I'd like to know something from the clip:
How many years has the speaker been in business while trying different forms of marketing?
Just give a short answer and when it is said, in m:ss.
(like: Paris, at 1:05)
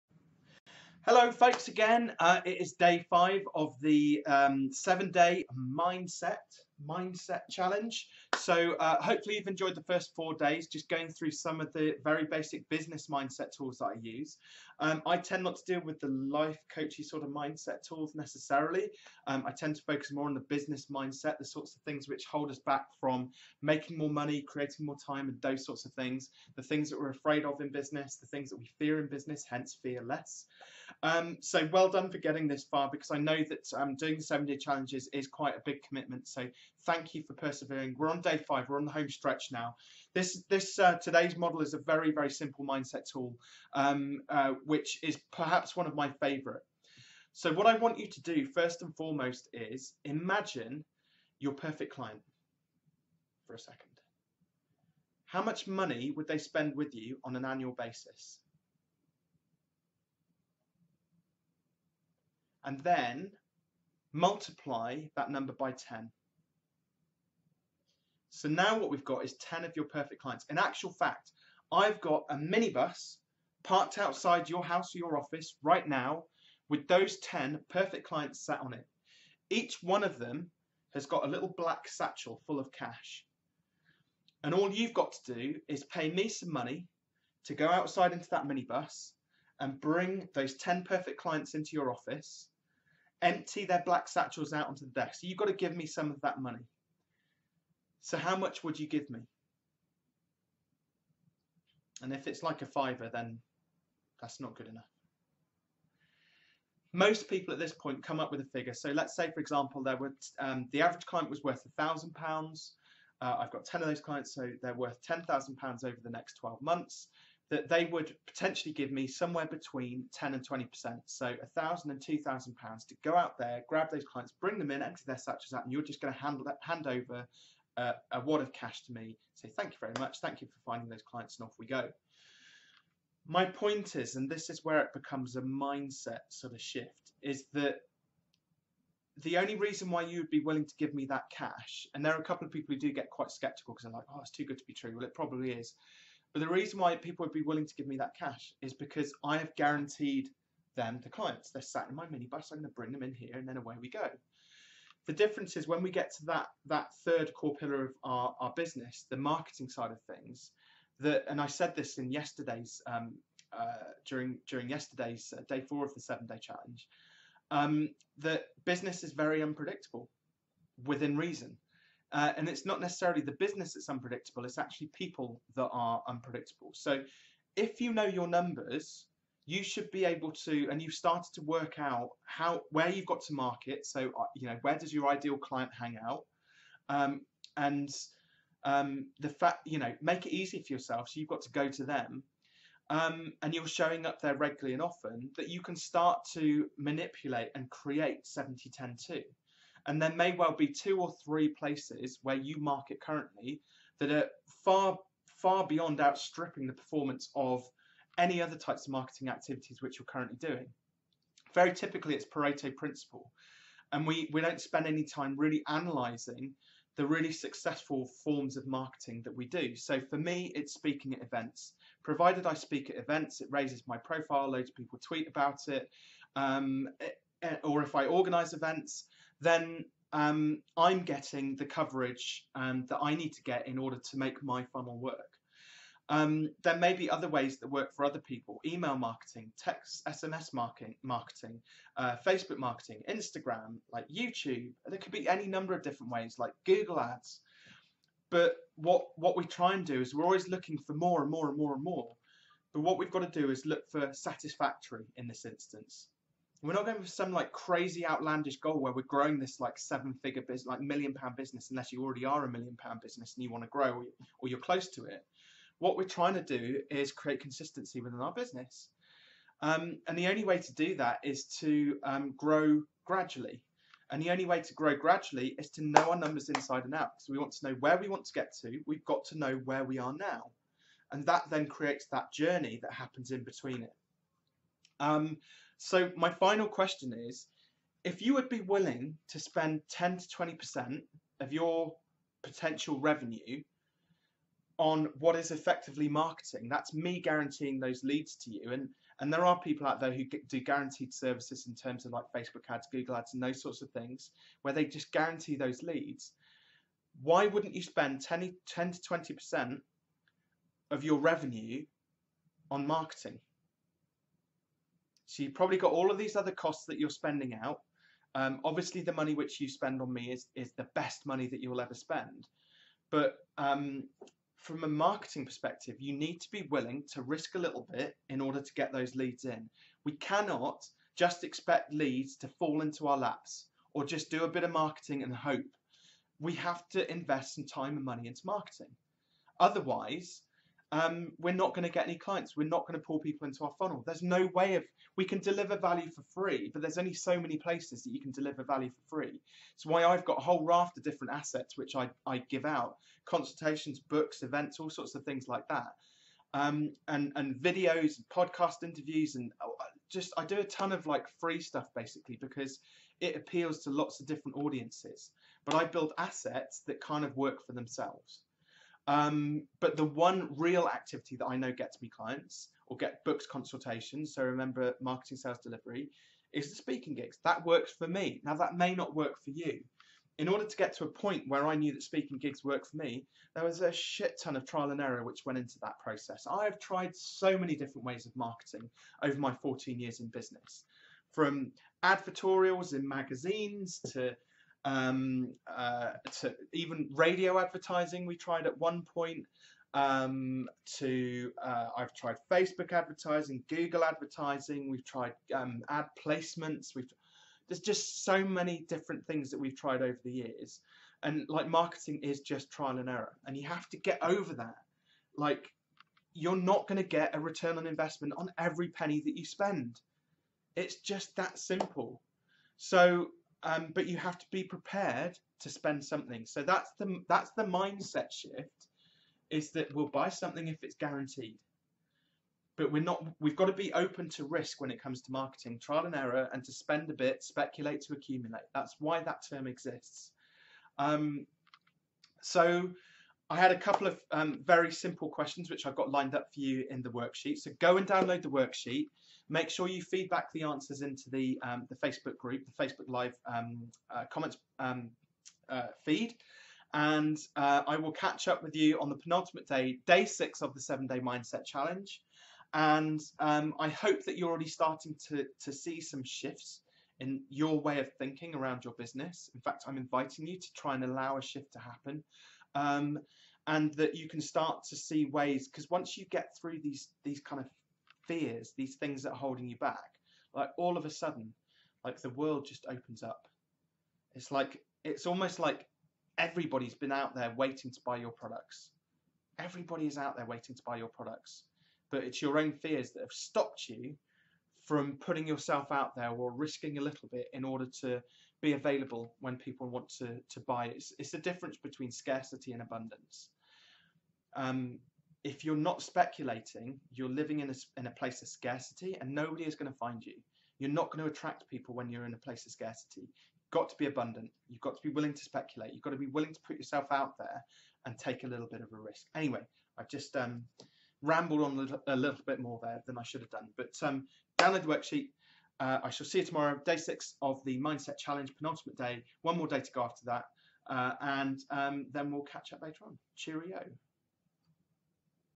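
14, at 6:29.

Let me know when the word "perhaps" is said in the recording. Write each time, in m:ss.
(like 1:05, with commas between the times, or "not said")
0:45.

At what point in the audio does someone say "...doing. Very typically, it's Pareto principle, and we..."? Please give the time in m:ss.
3:30.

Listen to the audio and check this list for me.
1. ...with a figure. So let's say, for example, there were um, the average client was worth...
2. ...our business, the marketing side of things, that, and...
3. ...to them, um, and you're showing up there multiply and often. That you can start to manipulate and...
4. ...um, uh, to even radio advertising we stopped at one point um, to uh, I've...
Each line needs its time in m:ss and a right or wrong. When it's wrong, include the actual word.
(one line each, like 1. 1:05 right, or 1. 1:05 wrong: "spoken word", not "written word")
1. 1:48 right
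2. 2:38 right
3. 3:11 wrong: "regularly", not "multiply"
4. 6:34 wrong: "tried", not "stopped".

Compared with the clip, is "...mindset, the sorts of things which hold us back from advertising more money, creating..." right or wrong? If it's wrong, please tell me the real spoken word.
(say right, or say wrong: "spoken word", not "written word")
wrong: "making", not "advertising".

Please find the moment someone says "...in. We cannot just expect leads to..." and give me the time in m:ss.
5:29.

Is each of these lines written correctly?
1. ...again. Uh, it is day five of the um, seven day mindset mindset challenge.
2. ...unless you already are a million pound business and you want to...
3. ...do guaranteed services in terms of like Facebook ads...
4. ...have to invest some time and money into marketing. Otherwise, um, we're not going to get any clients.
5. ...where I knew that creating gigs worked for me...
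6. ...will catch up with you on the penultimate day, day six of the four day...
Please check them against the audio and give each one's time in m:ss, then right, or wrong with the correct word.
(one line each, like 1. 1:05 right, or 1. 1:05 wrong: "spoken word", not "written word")
1. 0:01 right
2. 4:21 right
3. 5:00 right
4. 5:36 right
5. 6:21 wrong: "speaking", not "creating"
6. 7:37 wrong: "seven", not "four".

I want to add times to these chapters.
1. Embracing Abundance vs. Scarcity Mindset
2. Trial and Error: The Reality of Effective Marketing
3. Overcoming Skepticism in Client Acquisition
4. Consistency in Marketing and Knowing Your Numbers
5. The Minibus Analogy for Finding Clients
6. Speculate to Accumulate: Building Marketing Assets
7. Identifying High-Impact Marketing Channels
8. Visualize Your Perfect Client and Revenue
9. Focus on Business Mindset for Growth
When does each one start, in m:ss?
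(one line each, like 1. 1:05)
1. 7:20
2. 5:50
3. 2:45
4. 3:30
5. 2:00
6. 6:32
7. 4:12
8. 1:05
9. 0:27.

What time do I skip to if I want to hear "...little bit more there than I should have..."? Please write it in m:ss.
8:42.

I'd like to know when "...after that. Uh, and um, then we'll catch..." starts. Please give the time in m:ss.
8:50.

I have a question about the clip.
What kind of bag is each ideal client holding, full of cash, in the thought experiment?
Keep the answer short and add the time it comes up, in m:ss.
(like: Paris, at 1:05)
little black satchel, at 1:21.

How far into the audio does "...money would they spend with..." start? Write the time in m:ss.
0:55.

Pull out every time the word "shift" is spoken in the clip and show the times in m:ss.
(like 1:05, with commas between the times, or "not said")
2:16, 7:08, 7:46, 7:51.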